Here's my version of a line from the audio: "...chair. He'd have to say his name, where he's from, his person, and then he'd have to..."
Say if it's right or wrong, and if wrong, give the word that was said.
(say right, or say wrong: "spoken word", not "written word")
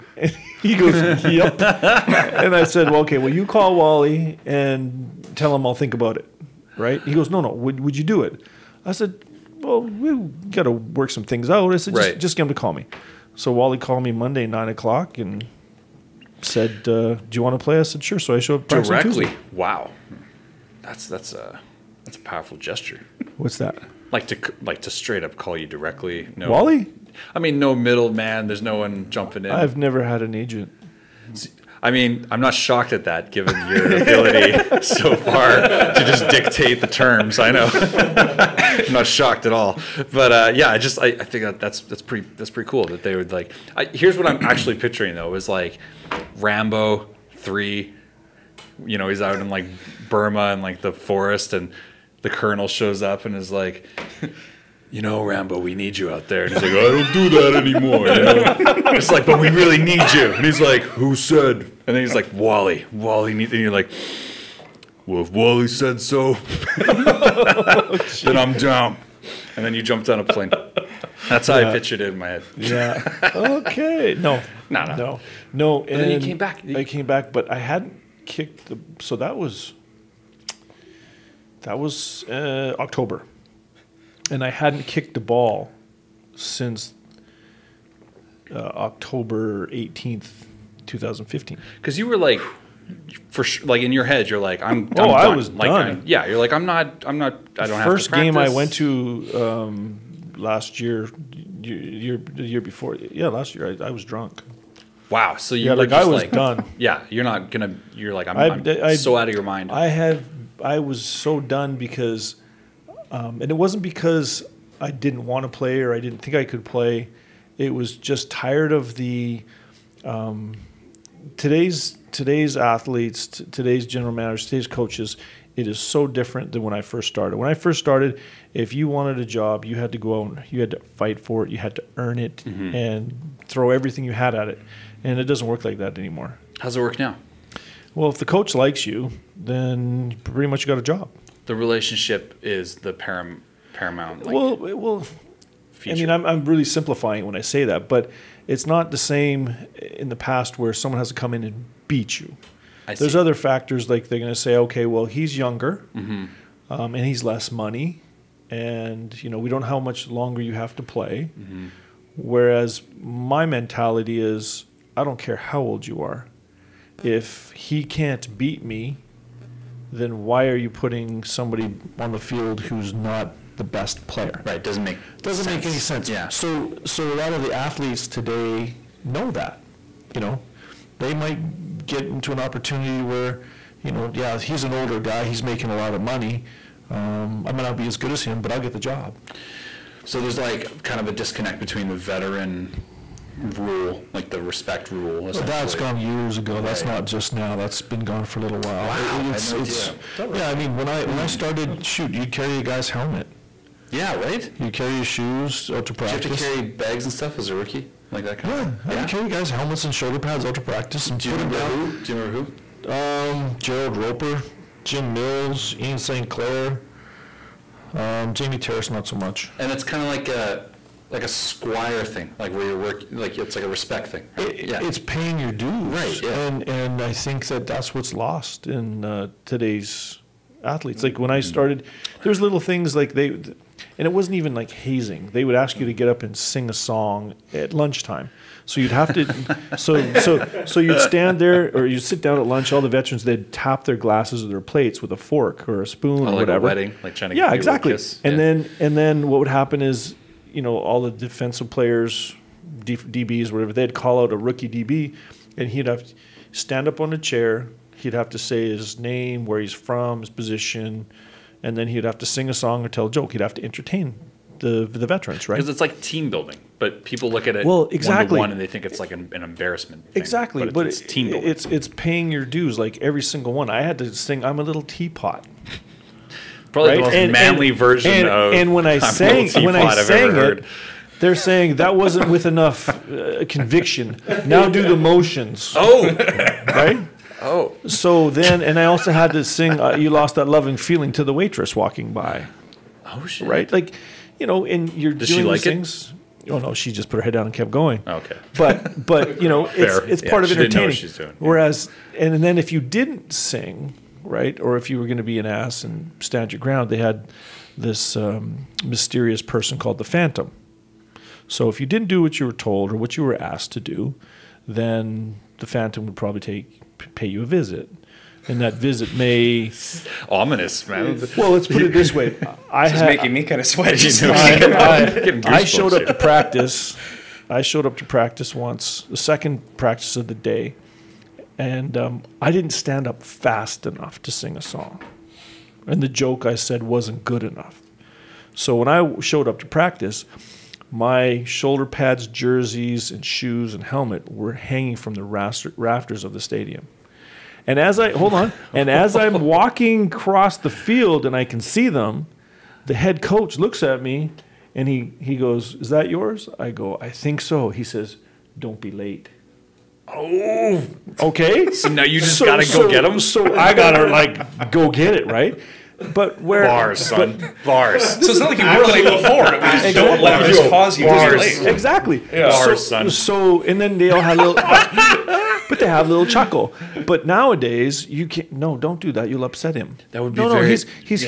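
wrong: "position", not "person".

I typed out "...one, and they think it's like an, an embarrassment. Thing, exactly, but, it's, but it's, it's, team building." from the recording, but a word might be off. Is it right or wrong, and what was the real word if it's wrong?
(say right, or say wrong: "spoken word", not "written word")
right.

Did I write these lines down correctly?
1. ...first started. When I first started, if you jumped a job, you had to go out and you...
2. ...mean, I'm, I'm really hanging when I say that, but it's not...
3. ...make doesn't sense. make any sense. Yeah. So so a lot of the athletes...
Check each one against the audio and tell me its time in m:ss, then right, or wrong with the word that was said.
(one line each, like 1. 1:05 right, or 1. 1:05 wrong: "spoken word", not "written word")
1. 2:06 wrong: "wanted", not "jumped"
2. 2:25 wrong: "simplifying", not "hanging"
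3. 2:54 right.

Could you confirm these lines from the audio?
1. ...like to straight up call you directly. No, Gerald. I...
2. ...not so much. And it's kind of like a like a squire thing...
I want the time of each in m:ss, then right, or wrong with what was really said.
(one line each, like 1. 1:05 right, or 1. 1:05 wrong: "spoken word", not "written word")
1. 0:24 wrong: "Wally", not "Gerald"
2. 3:38 right.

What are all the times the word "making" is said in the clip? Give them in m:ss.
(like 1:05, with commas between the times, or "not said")
3:05, 5:23.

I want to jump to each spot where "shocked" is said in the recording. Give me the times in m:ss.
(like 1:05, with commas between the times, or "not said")
0:32, 0:39.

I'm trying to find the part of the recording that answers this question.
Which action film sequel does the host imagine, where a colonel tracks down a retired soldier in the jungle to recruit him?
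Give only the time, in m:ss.
0:46.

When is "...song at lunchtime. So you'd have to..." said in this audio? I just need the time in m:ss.
3:56.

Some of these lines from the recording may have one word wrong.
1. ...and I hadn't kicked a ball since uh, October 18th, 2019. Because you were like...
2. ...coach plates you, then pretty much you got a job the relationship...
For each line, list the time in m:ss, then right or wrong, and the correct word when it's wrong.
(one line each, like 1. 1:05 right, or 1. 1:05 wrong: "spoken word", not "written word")
1. 1:24 wrong: "2015", not "2019"
2. 2:18 wrong: "likes", not "plates".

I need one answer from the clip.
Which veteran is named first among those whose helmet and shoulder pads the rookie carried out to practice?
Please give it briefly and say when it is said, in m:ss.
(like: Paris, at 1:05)
Gerald Roper, at 3:33.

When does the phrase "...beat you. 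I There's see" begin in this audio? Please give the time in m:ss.
2:31.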